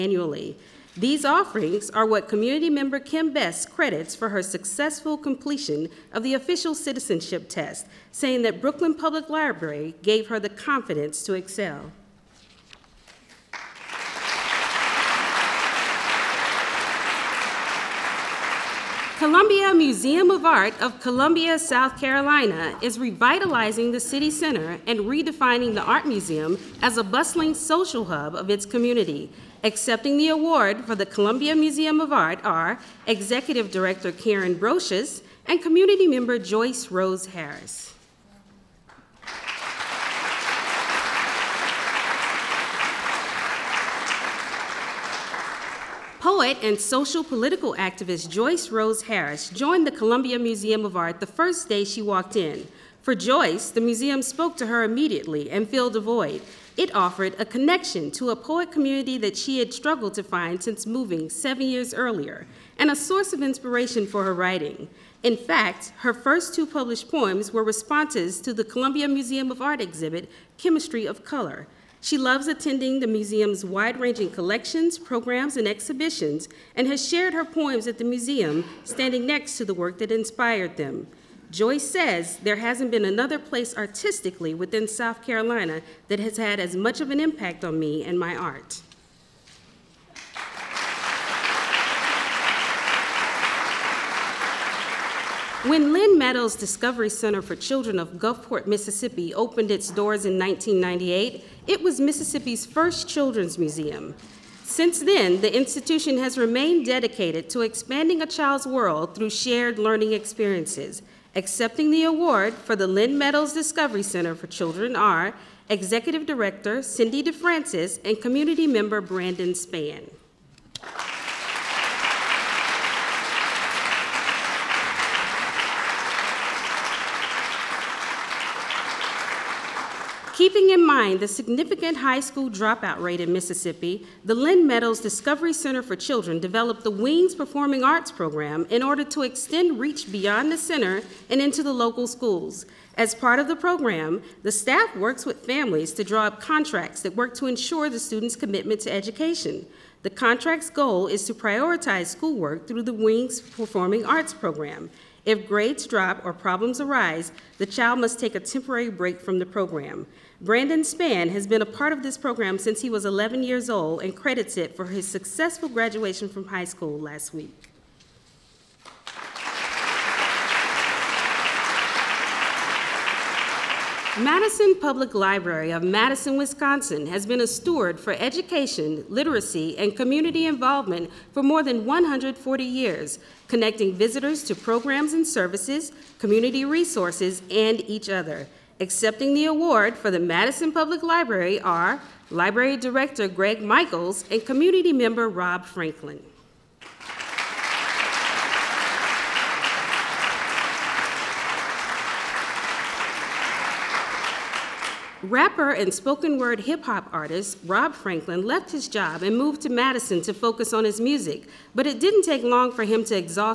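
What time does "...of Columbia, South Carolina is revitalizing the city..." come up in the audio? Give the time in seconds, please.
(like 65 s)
20 s.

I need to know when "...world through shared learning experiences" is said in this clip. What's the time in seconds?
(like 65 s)
108 s.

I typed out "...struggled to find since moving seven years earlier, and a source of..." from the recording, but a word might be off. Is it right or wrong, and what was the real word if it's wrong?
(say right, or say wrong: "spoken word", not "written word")
right.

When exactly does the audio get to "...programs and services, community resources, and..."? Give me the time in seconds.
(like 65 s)
184 s.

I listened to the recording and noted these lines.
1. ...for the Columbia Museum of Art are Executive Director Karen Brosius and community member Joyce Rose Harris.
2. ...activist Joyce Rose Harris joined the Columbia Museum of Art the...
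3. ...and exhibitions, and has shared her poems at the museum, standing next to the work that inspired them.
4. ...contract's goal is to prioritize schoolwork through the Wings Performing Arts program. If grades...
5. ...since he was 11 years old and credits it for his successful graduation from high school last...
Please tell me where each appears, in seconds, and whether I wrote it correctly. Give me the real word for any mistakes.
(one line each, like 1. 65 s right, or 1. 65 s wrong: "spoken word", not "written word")
1. 30 s right
2. 47 s right
3. 75 s right
4. 150 s right
5. 162 s right.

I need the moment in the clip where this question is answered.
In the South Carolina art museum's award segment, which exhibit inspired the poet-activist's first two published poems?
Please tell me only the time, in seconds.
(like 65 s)
70 s.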